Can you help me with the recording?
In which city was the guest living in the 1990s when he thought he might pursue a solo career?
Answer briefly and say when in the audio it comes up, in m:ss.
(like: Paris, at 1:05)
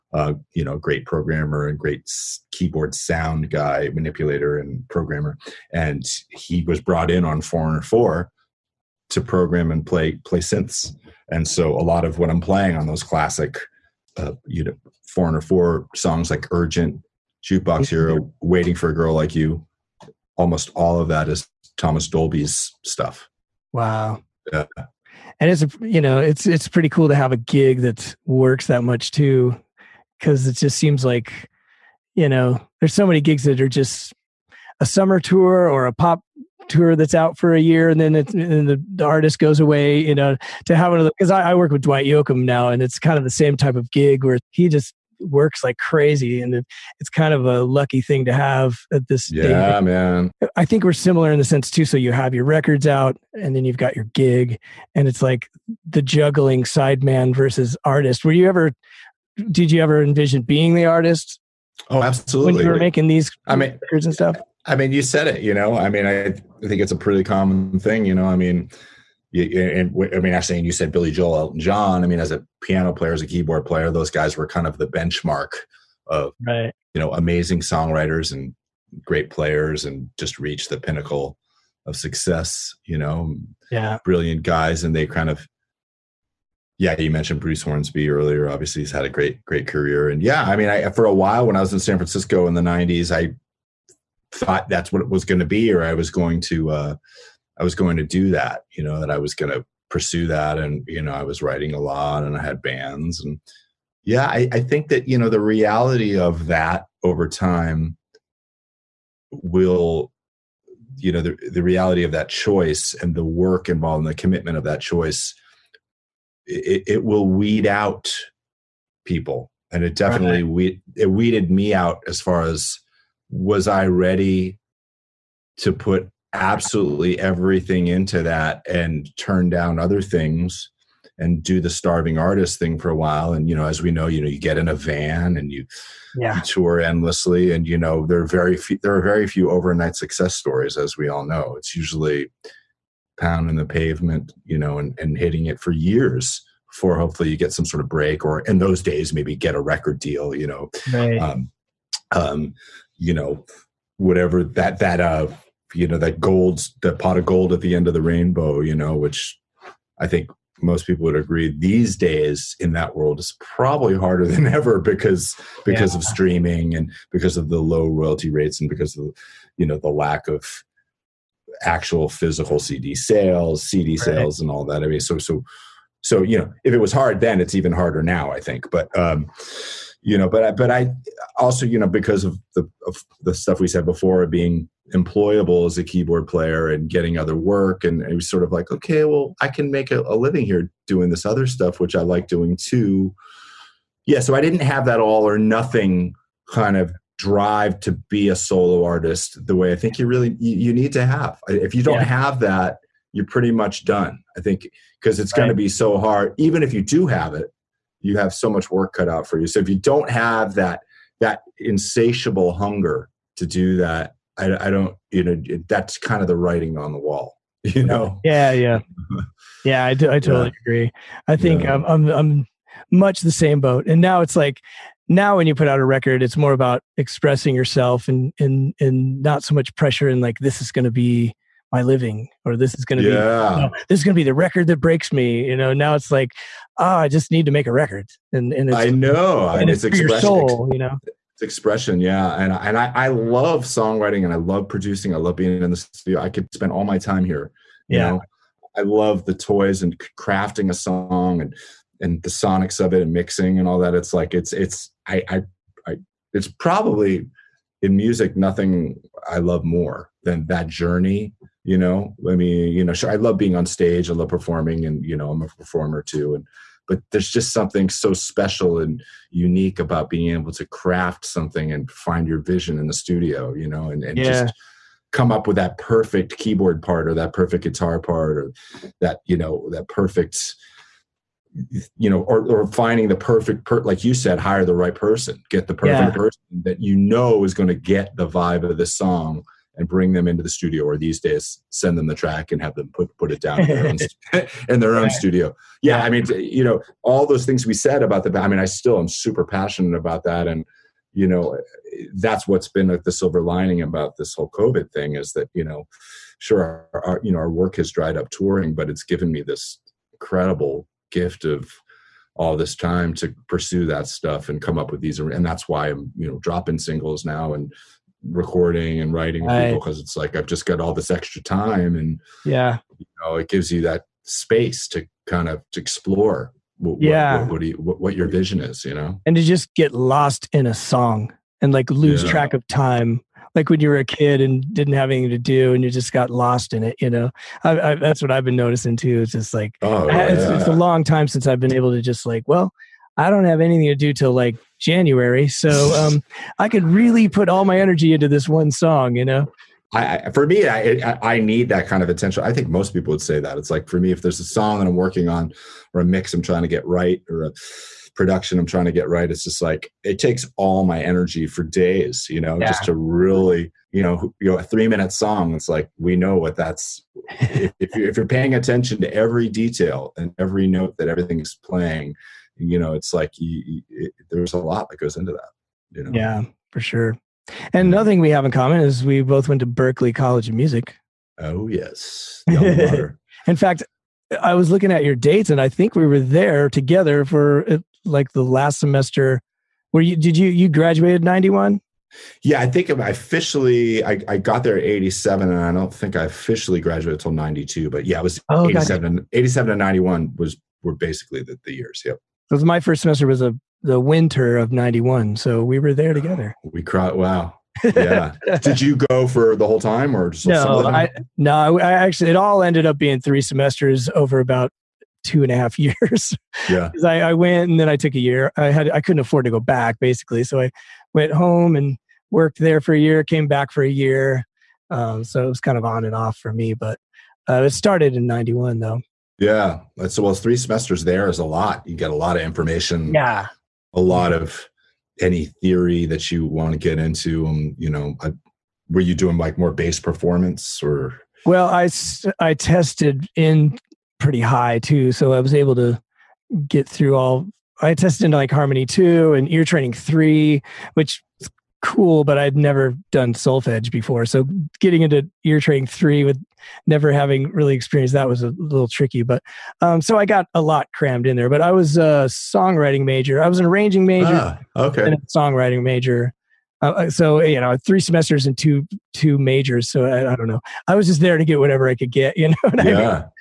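San Francisco, at 1:31.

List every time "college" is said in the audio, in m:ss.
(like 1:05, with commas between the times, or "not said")
6:20.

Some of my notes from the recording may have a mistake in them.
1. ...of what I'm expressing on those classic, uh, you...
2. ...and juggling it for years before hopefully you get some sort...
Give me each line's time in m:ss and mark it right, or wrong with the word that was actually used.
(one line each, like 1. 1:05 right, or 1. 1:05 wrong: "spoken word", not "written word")
1. 0:12 wrong: "playing", not "expressing"
2. 2:24 wrong: "hitting", not "juggling".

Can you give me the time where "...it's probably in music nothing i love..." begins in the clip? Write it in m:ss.
4:16.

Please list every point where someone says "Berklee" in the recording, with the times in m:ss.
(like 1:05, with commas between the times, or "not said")
6:19.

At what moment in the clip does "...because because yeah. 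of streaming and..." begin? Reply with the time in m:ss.
2:44.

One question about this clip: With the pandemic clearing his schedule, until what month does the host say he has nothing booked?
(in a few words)
January.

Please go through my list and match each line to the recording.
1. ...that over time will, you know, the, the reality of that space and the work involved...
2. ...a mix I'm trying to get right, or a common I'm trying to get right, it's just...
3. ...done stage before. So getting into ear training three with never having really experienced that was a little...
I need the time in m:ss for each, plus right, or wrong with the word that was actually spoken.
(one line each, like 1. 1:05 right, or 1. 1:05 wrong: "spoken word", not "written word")
1. 1:46 wrong: "choice", not "space"
2. 5:55 wrong: "production", not "common"
3. 7:33 wrong: "solfege", not "stage".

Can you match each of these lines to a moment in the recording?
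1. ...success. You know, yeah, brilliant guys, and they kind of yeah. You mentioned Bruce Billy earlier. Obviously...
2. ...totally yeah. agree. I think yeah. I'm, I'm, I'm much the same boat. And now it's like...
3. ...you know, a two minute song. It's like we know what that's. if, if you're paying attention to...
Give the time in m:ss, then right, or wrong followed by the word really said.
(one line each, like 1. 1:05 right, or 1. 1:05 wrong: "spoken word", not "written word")
1. 1:21 wrong: "Hornsby", not "Billy"
2. 3:40 right
3. 6:04 wrong: "three", not "two".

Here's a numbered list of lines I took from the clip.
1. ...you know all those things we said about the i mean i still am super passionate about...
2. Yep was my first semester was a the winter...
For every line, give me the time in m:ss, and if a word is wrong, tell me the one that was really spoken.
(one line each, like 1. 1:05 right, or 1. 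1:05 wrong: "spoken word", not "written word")
1. 4:56 right
2. 6:42 right.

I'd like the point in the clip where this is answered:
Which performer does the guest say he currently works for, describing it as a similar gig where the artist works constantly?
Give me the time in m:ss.
0:41.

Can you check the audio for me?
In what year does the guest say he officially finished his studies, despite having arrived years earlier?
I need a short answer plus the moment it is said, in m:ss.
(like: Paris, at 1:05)
1992, at 6:37.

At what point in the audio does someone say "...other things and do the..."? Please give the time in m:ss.
2:09.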